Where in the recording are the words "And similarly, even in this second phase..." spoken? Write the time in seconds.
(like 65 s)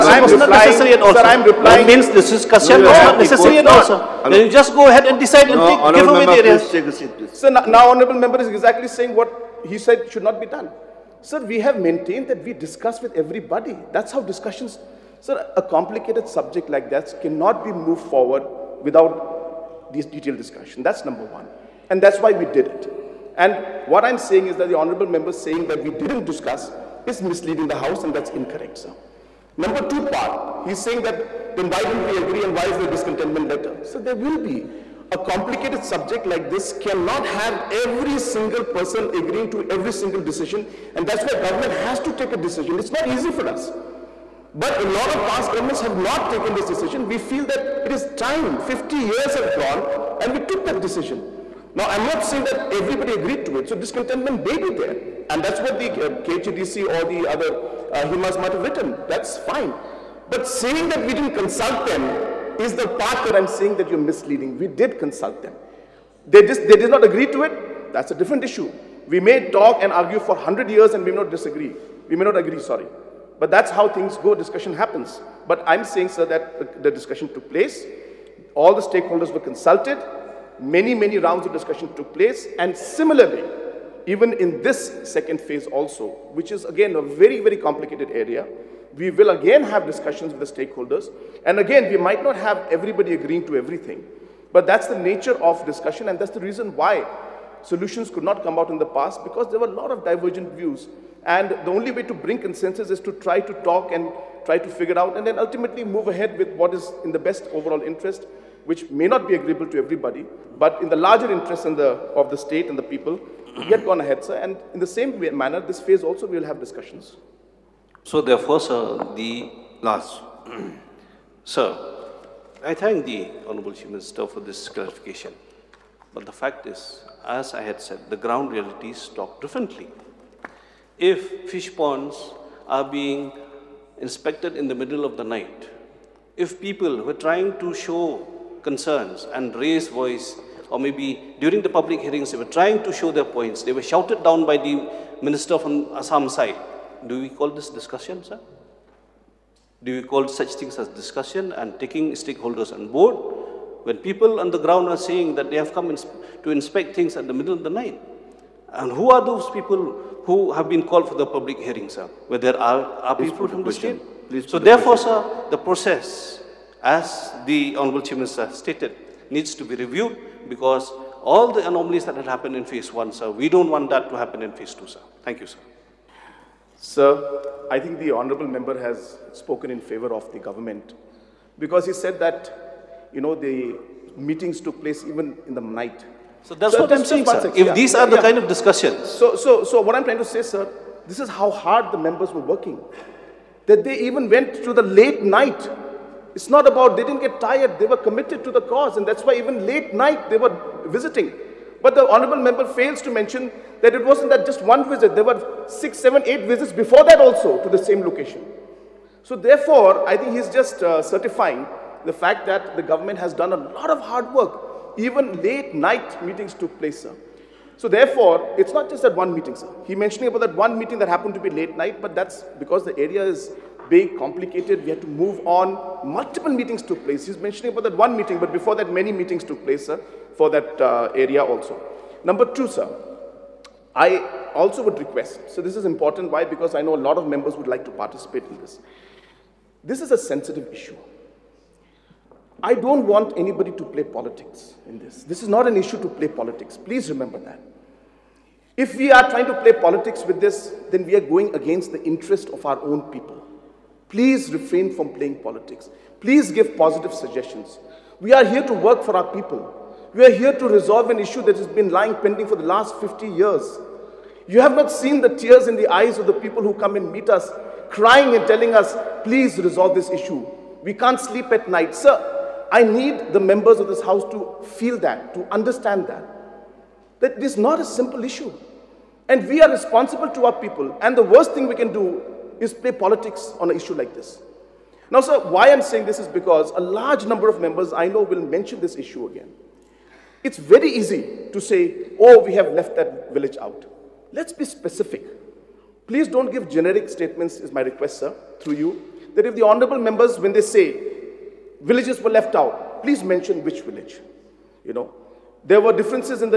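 82 s.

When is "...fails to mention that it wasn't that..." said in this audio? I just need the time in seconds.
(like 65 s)
202 s.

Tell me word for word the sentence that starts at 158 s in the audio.
And who are those people who have been called for the public hearings, sir, where there are, are people from the state?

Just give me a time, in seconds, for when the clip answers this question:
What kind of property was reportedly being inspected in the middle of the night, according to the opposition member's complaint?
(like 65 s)
131 s.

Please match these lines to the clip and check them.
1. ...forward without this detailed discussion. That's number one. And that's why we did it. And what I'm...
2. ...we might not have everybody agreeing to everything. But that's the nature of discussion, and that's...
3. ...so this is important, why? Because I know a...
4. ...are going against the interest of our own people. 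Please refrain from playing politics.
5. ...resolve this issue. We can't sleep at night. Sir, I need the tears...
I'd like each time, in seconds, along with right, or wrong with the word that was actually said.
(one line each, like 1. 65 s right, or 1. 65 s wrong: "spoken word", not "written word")
1. 18 s right
2. 91 s right
3. 235 s right
4. 251 s right
5. 269 s wrong: "members", not "tears".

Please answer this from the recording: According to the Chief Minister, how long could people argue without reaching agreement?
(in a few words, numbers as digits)
100 years.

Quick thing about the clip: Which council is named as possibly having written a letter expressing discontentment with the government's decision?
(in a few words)
KHDC.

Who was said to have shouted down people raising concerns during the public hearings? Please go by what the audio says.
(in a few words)
Minister from Assam.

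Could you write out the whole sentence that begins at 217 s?
So therefore, it's not just that one meeting, sir.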